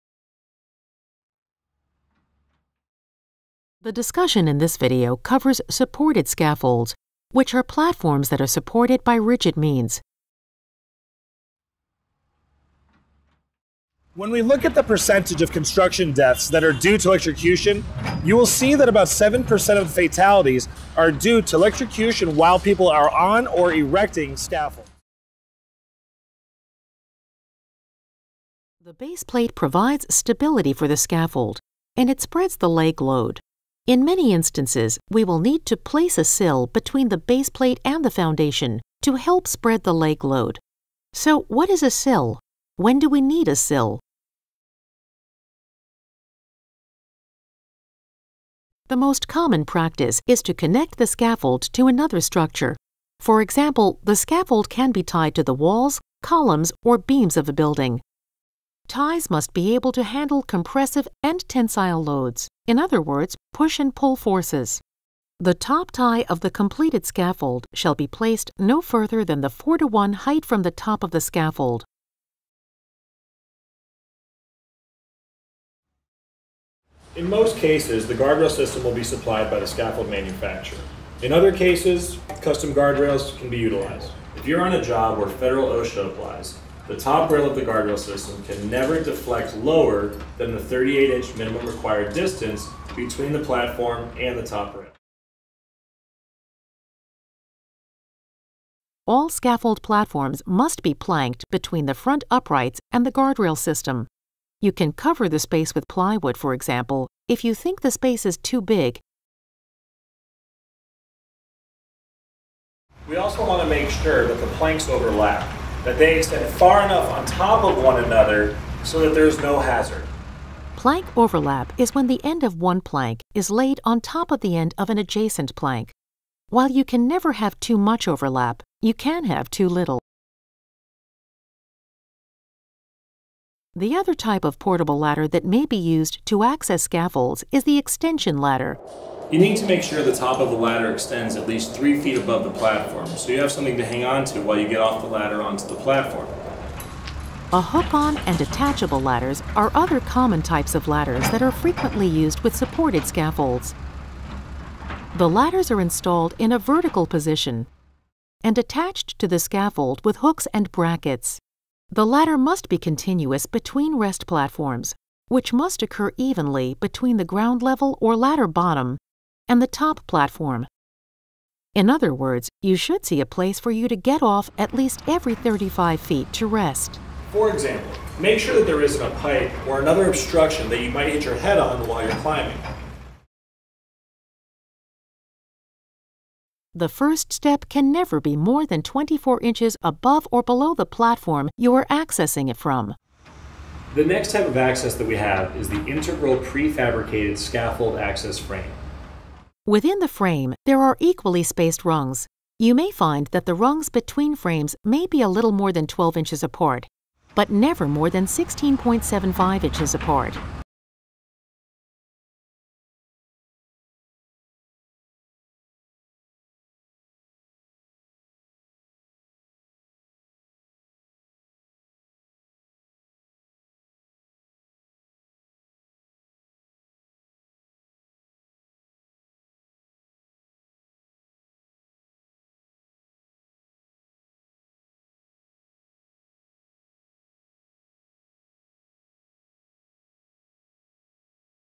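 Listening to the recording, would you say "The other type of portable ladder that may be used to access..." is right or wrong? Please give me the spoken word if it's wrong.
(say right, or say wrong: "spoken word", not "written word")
right.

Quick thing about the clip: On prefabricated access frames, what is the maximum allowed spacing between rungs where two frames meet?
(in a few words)
16.75 inches.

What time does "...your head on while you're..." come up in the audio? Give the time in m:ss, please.
3:01.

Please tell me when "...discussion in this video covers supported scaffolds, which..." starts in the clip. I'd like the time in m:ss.
0:03.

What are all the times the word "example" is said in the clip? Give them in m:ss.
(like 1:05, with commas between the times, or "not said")
0:53, 1:46, 2:57.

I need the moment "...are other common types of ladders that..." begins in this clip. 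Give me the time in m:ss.
2:29.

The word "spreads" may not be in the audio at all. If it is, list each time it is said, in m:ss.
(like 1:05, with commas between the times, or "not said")
0:32, 0:39.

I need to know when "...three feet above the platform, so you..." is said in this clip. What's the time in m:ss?
2:21.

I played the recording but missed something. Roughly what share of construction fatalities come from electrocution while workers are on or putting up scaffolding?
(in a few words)
7%.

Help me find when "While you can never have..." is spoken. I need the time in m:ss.
2:06.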